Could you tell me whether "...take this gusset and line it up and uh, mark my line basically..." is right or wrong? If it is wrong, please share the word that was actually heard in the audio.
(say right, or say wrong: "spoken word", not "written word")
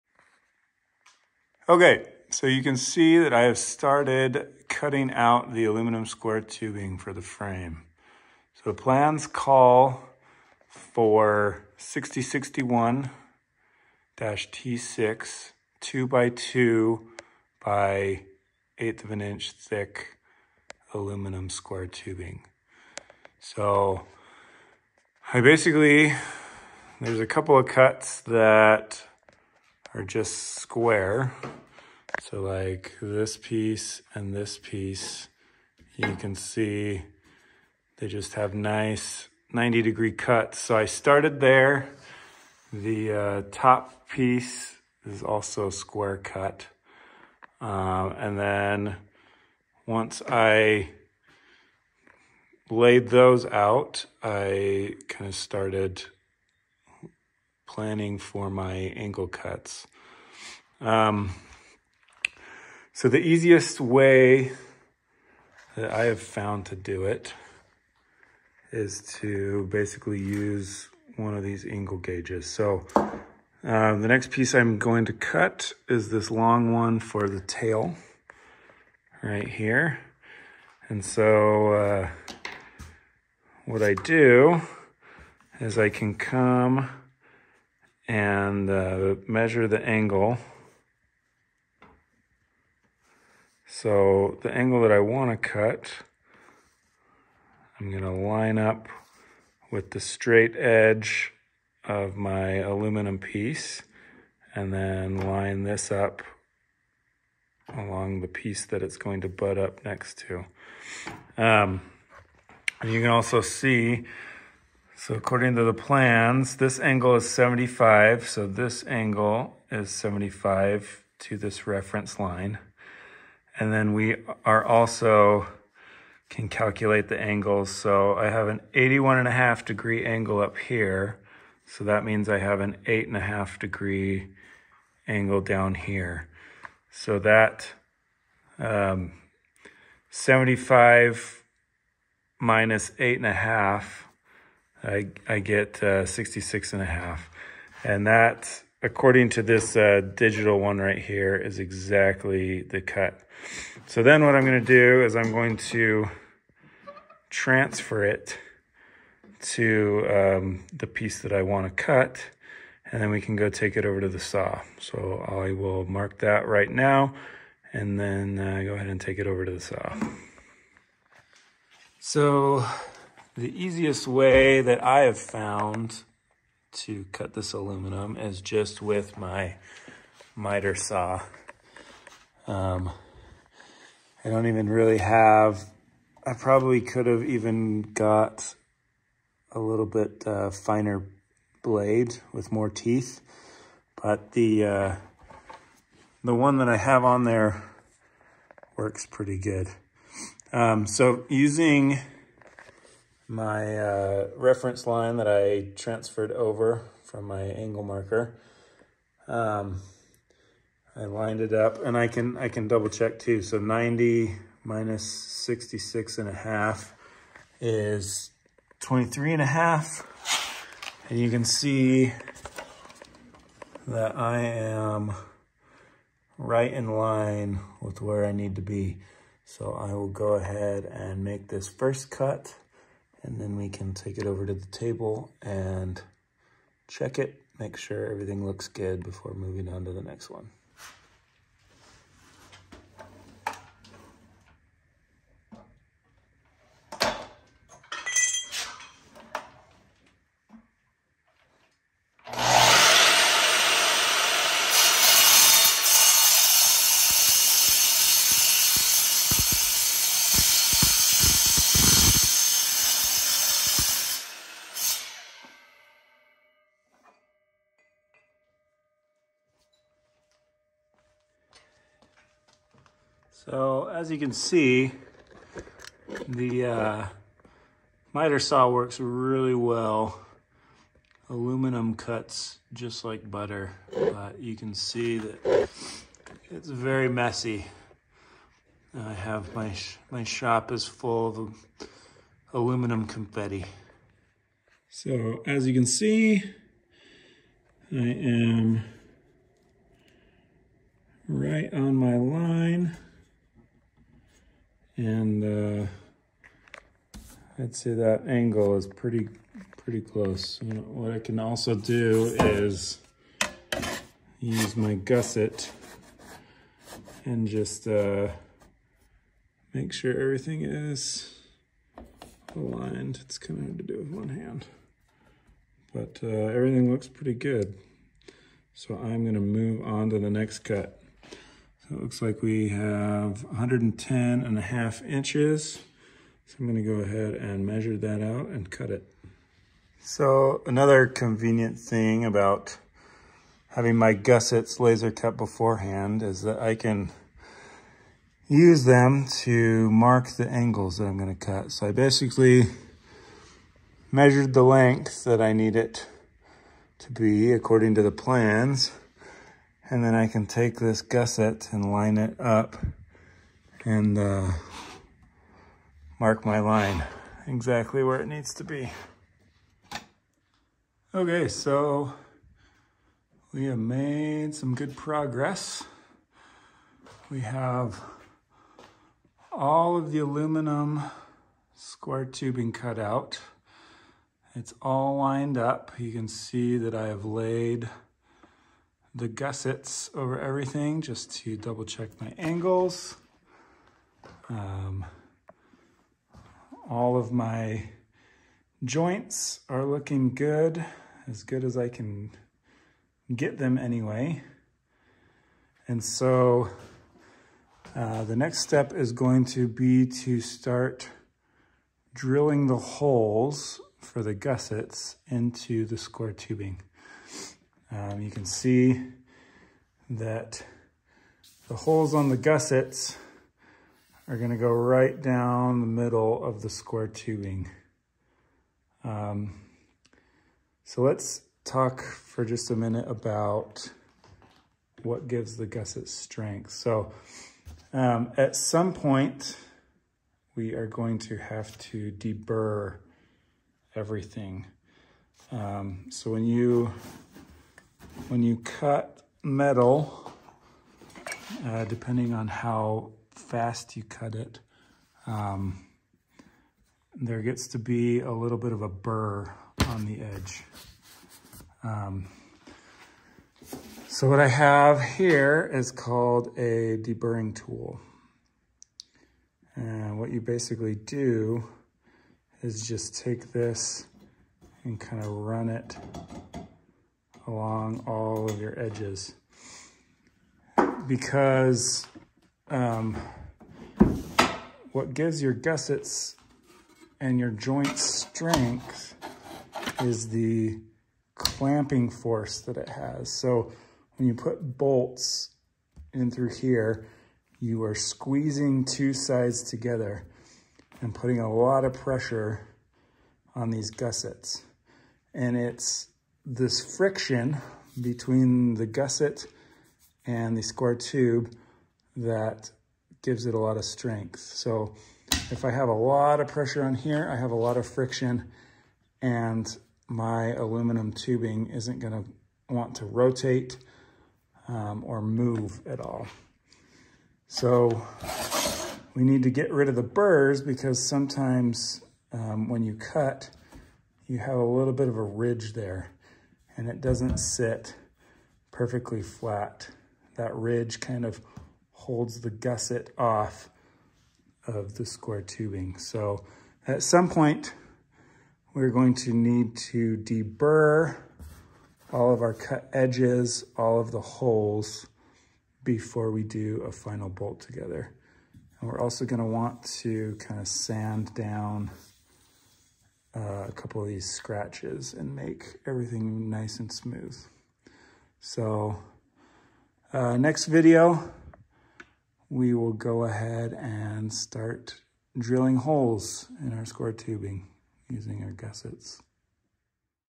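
wrong: "exactly", not "basically".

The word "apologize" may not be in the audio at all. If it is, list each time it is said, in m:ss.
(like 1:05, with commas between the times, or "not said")
not said.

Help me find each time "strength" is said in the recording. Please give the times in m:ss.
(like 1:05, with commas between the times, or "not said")
7:16, 8:07, 8:33.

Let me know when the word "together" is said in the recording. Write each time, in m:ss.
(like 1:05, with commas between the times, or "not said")
8:19, 9:17.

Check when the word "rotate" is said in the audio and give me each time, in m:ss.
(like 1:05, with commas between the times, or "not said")
8:43.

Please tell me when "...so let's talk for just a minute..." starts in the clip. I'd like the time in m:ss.
7:10.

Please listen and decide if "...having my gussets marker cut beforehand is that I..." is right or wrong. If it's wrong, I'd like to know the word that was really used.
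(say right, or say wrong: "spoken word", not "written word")
wrong: "laser", not "marker".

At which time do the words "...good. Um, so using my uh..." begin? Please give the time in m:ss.
3:19.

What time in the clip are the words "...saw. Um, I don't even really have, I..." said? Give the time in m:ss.
3:00.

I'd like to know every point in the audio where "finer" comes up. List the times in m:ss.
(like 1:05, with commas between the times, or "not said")
3:10.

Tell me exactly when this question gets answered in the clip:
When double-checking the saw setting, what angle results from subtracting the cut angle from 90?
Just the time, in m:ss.
3:38.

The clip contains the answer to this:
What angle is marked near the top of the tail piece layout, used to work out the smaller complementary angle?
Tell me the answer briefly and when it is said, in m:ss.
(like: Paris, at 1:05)
81.5 degrees, at 2:08.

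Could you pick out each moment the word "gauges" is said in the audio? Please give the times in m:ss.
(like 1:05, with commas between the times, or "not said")
1:11.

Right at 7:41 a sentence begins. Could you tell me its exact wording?
Um, so what I have here is called a deburring tool.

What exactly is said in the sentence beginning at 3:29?
Um, I lined it up and I can, I can double check too.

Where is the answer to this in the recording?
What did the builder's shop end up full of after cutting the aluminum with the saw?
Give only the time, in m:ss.
4:52.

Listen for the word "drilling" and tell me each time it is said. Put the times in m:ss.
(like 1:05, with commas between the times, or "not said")
6:52, 9:35.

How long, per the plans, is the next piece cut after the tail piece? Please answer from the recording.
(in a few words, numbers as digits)
110.5 inches.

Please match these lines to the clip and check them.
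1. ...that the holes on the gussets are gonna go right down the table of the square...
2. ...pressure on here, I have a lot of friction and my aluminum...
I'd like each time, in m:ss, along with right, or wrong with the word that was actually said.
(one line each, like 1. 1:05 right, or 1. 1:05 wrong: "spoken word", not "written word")
1. 7:00 wrong: "middle", not "table"
2. 8:36 right.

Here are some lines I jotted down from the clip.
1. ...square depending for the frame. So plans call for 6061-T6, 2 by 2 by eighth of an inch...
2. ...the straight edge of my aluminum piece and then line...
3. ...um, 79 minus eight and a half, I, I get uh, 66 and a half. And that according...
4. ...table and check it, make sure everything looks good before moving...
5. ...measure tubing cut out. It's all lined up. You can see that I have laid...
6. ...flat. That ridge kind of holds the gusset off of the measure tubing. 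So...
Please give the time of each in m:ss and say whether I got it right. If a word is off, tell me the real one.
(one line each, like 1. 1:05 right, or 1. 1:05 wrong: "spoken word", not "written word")
1. 0:06 wrong: "tubing", not "depending"
2. 1:39 right
3. 2:18 wrong: "75", not "79"
4. 3:54 right
5. 6:21 wrong: "square", not "measure"
6. 8:59 wrong: "square", not "measure".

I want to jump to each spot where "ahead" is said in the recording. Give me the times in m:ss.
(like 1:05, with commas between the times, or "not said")
2:48, 3:50, 5:37, 9:33.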